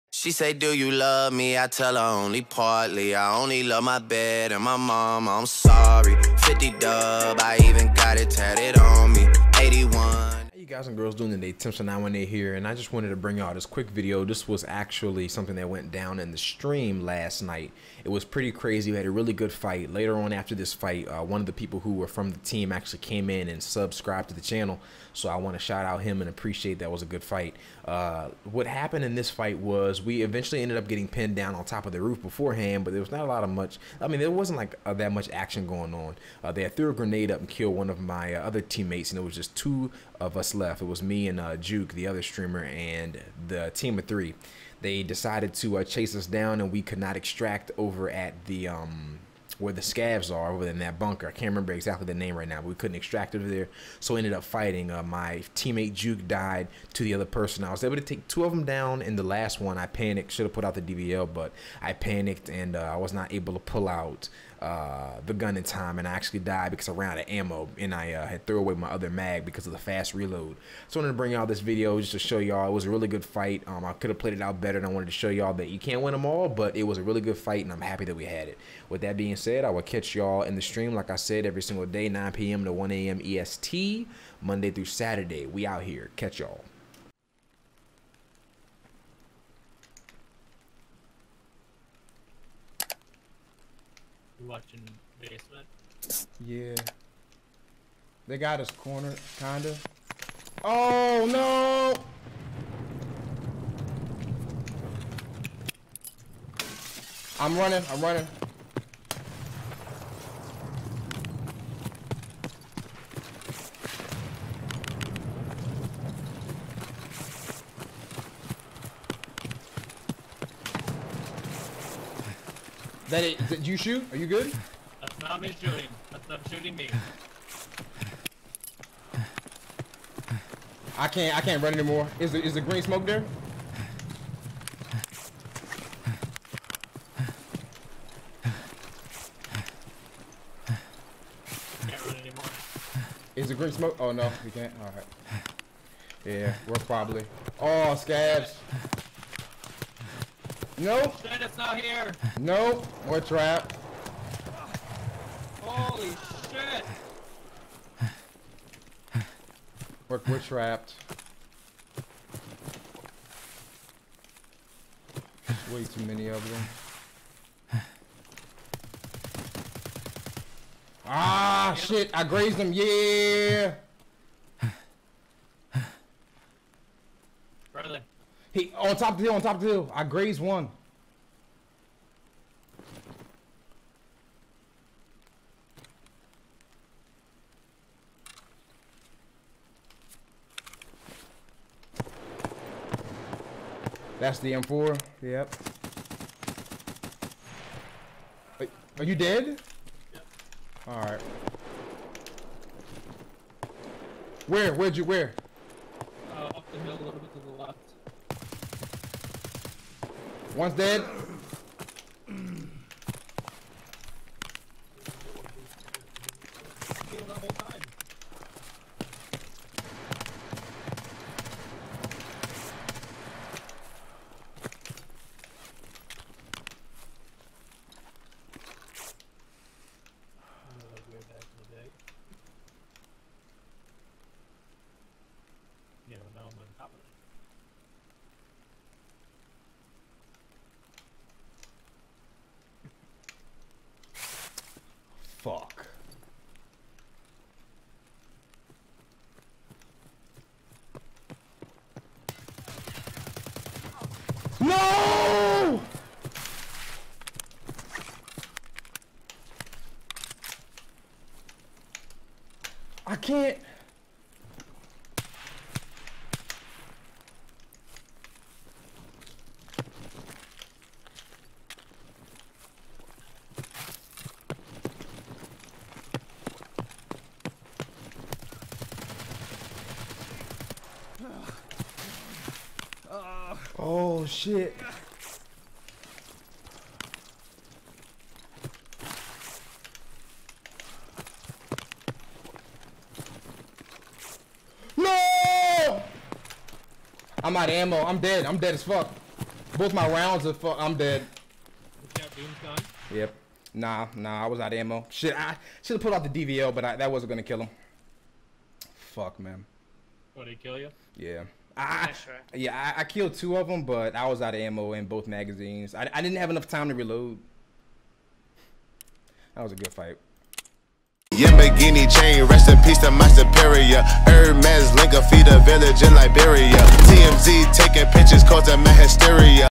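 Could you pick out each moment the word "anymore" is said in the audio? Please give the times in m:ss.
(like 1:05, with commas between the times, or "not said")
2:11, 2:22.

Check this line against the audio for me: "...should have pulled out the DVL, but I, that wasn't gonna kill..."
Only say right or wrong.
right.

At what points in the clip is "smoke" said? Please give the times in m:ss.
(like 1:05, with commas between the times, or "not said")
2:12, 2:23.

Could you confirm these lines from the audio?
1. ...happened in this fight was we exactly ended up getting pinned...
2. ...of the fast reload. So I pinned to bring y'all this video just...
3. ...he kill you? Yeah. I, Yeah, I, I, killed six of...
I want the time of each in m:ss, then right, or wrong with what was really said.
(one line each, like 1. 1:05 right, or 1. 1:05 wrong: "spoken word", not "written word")
1. 0:28 wrong: "eventually", not "exactly"
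2. 1:09 wrong: "wanted", not "pinned"
3. 5:10 wrong: "two", not "six".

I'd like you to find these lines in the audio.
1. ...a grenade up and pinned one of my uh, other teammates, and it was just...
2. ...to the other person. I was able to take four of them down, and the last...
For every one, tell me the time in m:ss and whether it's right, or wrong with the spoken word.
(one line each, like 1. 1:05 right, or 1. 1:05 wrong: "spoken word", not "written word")
1. 0:36 wrong: "killed", not "pinned"
2. 0:56 wrong: "two", not "four".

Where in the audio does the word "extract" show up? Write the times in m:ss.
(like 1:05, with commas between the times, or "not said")
0:47, 0:52.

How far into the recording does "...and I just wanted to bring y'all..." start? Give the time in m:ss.
0:12.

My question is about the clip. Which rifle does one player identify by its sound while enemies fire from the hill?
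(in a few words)
M4.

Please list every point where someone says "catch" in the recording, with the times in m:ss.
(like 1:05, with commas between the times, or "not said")
1:19, 1:26.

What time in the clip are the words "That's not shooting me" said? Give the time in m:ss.
2:06.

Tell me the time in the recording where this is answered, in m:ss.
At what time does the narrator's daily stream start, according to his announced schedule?
1:22.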